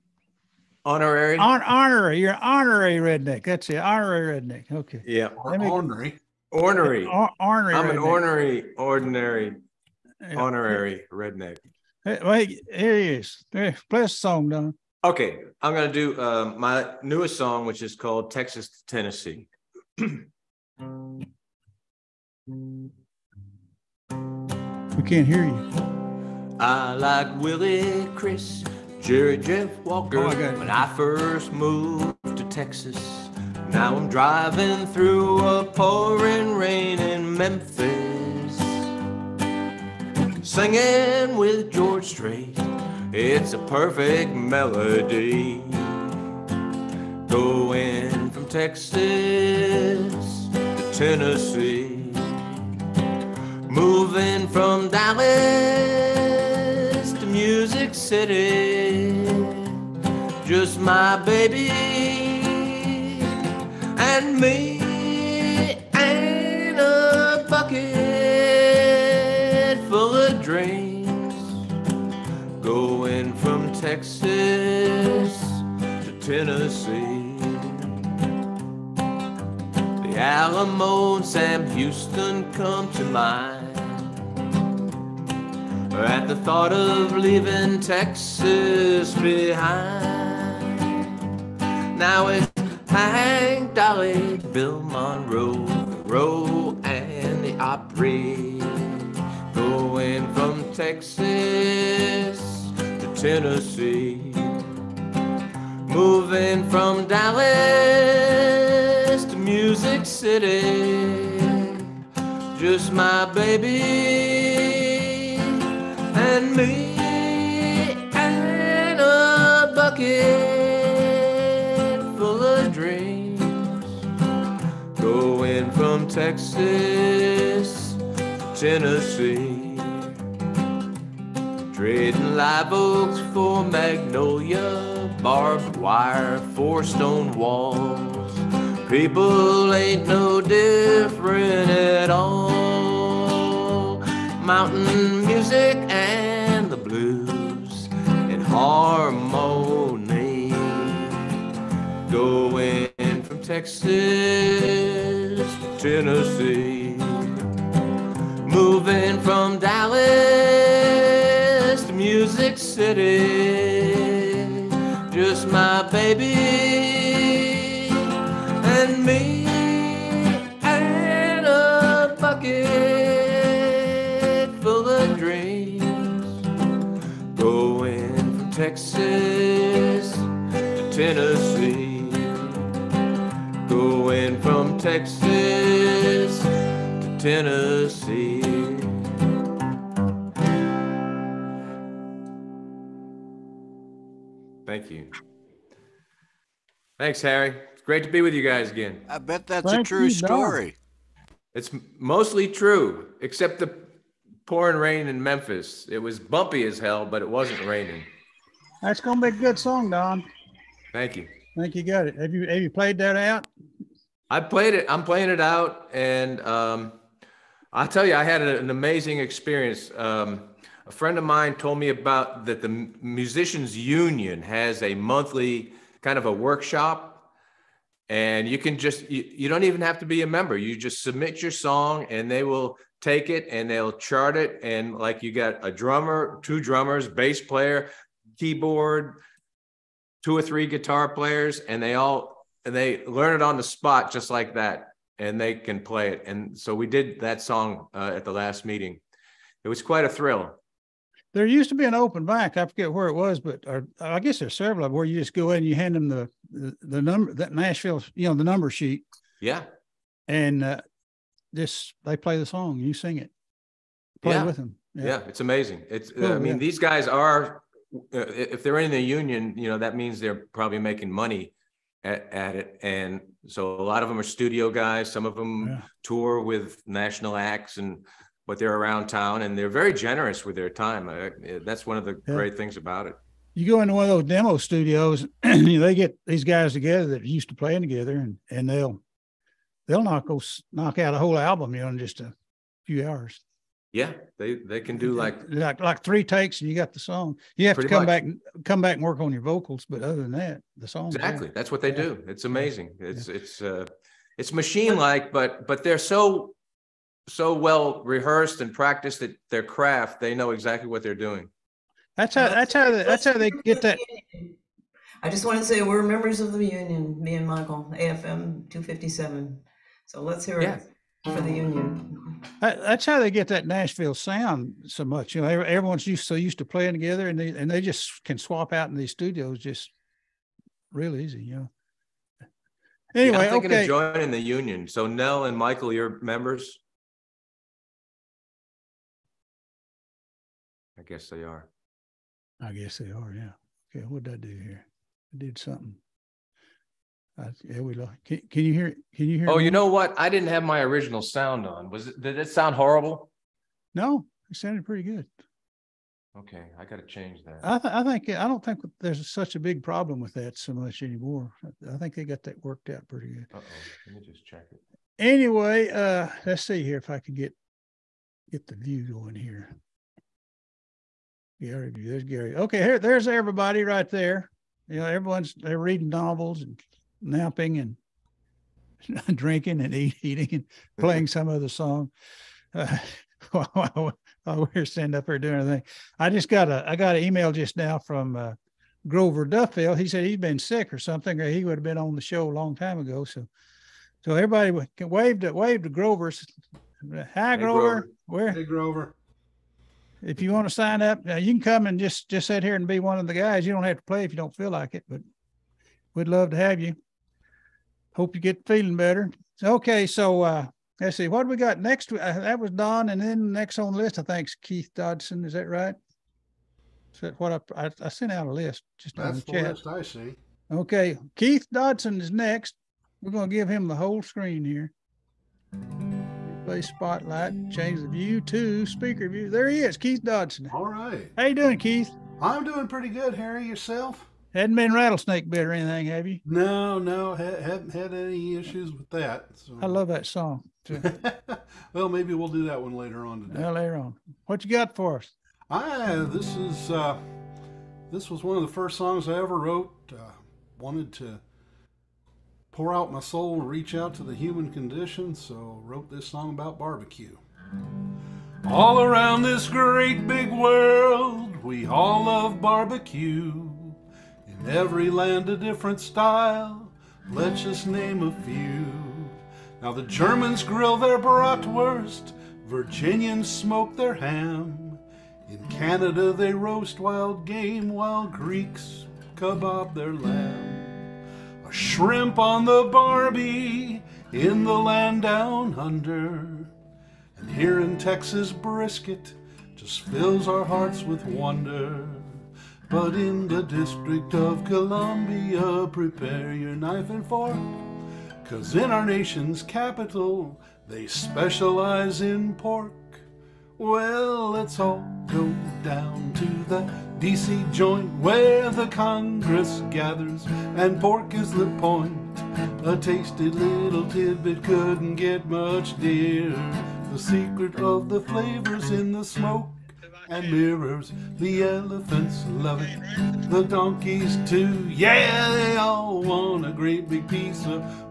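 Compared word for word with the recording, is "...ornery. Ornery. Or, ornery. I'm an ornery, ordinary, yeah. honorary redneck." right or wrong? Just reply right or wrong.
wrong.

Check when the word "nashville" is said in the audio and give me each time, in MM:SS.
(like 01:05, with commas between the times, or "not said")
04:17, 05:23.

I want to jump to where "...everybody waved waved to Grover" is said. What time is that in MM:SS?
06:34.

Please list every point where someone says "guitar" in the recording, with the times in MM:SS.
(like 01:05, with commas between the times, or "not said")
04:00.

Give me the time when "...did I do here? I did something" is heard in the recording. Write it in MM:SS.
05:44.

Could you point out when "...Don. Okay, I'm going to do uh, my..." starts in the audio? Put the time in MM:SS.
00:14.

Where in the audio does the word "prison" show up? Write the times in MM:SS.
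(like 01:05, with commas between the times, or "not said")
not said.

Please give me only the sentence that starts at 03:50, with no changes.
You just submit your song, and they will take it and they'll chart it.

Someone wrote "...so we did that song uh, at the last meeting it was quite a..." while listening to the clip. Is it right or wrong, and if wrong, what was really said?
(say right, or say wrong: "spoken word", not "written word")
right.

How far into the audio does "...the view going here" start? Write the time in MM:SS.
06:08.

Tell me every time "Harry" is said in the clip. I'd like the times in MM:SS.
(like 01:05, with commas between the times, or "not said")
03:17, 07:13.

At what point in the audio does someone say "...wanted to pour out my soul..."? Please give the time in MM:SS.
07:30.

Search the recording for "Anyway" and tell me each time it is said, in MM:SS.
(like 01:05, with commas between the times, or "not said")
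05:33, 06:05.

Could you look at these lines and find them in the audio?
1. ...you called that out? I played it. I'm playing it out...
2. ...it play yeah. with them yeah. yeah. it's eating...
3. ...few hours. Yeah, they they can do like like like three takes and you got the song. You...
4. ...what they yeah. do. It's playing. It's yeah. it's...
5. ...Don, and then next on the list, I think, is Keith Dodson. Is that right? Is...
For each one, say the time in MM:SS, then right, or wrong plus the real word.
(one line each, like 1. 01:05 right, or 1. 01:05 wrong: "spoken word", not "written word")
1. 03:32 wrong: "played", not "called"
2. 04:23 wrong: "amazing", not "eating"
3. 04:52 right
4. 05:01 wrong: "amazing", not "playing"
5. 06:52 right.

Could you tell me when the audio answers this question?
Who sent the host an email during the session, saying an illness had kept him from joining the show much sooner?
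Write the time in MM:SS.
06:29.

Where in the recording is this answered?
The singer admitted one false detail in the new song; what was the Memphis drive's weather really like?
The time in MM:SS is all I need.
03:26.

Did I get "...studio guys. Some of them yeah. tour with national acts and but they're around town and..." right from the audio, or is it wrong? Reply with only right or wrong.
right.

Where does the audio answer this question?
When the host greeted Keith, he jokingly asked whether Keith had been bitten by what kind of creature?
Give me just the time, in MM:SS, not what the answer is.
07:14.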